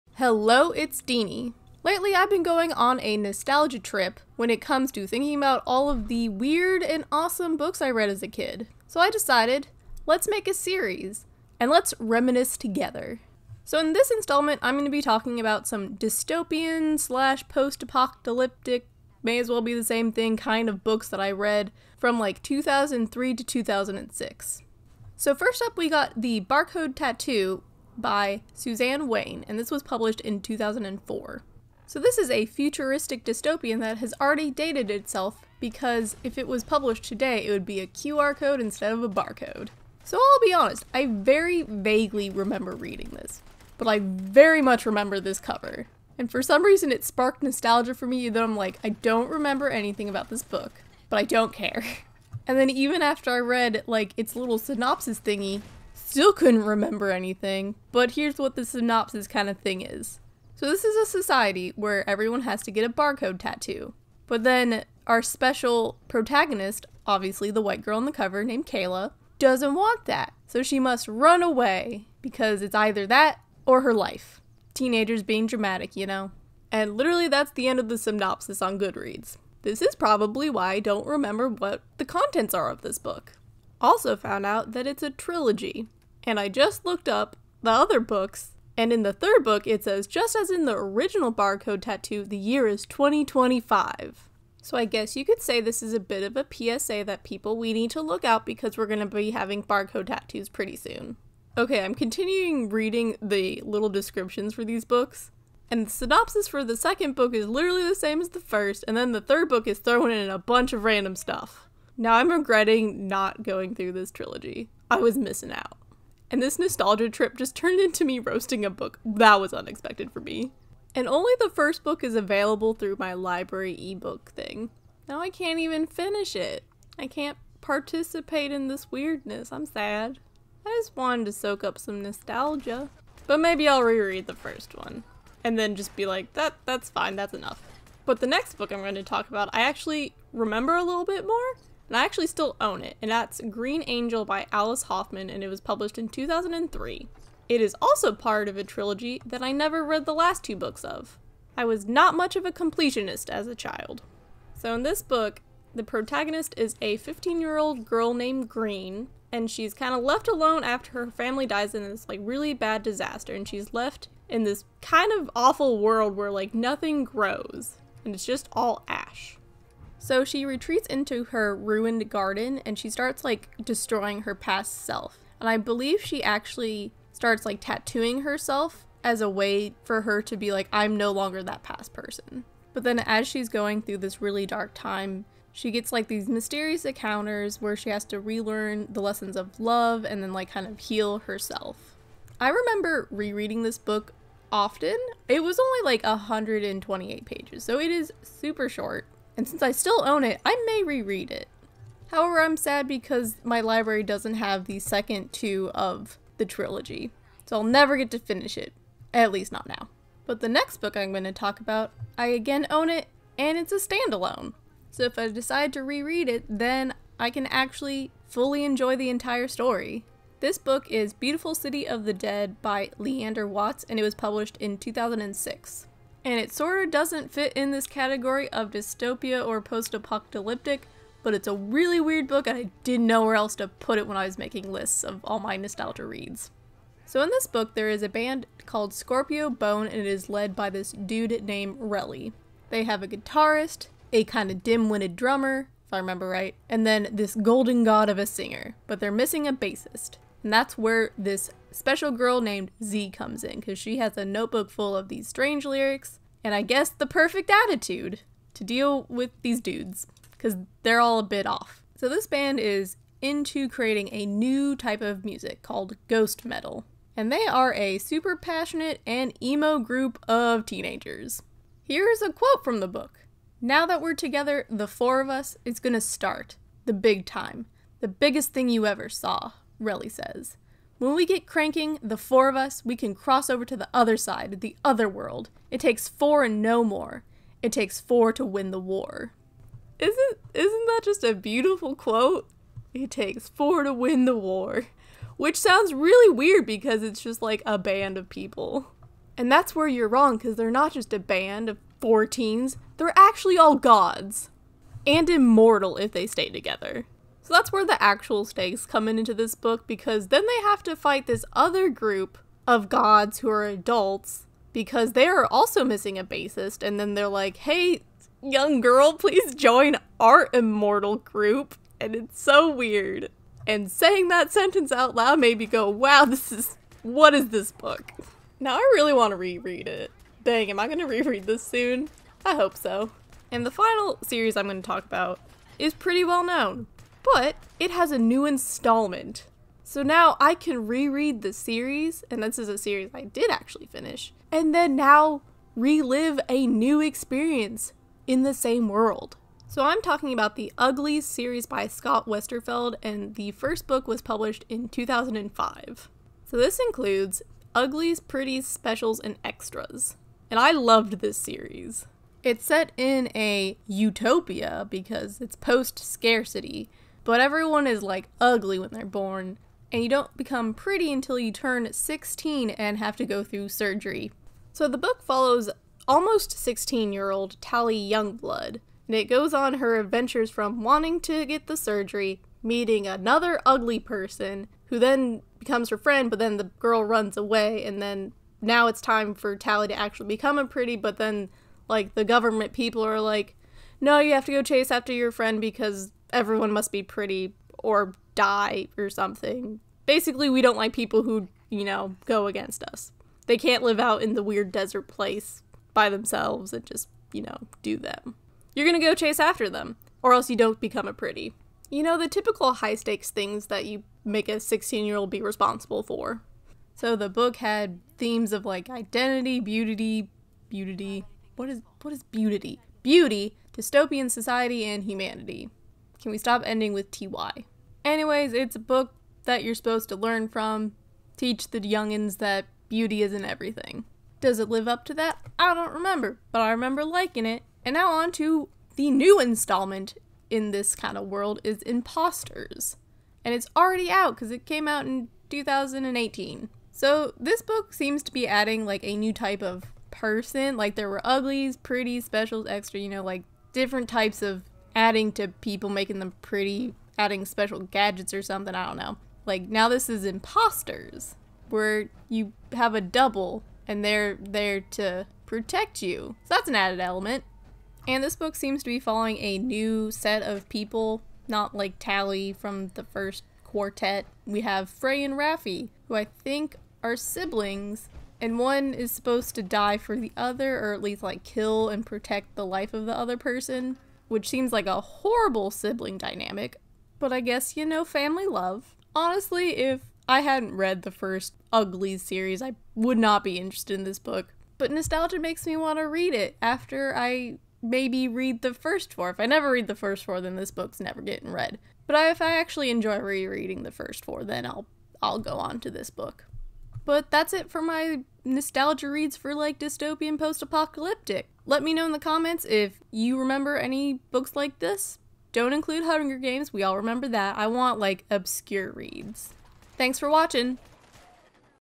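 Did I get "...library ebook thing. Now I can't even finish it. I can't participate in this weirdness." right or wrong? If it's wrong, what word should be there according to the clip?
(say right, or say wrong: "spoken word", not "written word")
right.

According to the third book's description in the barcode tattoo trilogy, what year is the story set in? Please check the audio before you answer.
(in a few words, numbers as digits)
2025.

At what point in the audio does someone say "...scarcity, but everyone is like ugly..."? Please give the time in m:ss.
6:05.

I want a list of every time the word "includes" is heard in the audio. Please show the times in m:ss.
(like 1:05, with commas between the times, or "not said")
5:56, 8:35.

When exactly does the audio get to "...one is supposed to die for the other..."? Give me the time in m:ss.
7:58.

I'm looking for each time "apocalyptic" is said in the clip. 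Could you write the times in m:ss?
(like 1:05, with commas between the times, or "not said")
0:17, 3:49, 8:30.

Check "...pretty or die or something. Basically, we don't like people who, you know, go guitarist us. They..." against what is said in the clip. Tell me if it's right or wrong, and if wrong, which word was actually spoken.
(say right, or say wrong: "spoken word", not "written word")
wrong: "against", not "guitarist".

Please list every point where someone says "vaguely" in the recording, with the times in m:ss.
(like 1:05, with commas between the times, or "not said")
0:41.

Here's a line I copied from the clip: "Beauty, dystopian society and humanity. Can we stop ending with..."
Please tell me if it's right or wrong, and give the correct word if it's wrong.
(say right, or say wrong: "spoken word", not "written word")
right.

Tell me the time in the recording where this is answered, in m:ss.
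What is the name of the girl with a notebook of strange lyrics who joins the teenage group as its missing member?
4:12.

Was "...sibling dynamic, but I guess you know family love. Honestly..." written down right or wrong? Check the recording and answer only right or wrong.
right.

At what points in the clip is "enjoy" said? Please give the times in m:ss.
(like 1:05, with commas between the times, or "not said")
3:38, 8:22.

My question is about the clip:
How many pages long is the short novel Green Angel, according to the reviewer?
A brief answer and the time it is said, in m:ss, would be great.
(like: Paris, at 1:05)
128, at 3:16.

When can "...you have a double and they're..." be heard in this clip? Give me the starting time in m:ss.
7:42.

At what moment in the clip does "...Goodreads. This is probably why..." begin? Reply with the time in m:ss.
1:18.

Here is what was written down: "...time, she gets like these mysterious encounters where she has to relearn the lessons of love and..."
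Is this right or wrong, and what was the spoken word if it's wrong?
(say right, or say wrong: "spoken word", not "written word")
right.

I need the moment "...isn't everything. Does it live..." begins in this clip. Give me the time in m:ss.
7:13.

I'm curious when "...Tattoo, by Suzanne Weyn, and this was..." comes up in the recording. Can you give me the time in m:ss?
0:26.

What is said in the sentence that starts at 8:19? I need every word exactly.
If I never read the first four, then this book's never getting read.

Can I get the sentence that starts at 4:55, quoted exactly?
Which sounds really weird because it's just like a band of people.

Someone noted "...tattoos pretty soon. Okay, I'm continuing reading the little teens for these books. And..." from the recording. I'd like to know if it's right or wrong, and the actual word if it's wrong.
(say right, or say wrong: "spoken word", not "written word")
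wrong: "descriptions", not "teens".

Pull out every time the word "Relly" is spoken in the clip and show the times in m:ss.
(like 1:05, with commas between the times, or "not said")
4:01, 4:39.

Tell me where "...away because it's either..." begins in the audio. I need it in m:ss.
1:11.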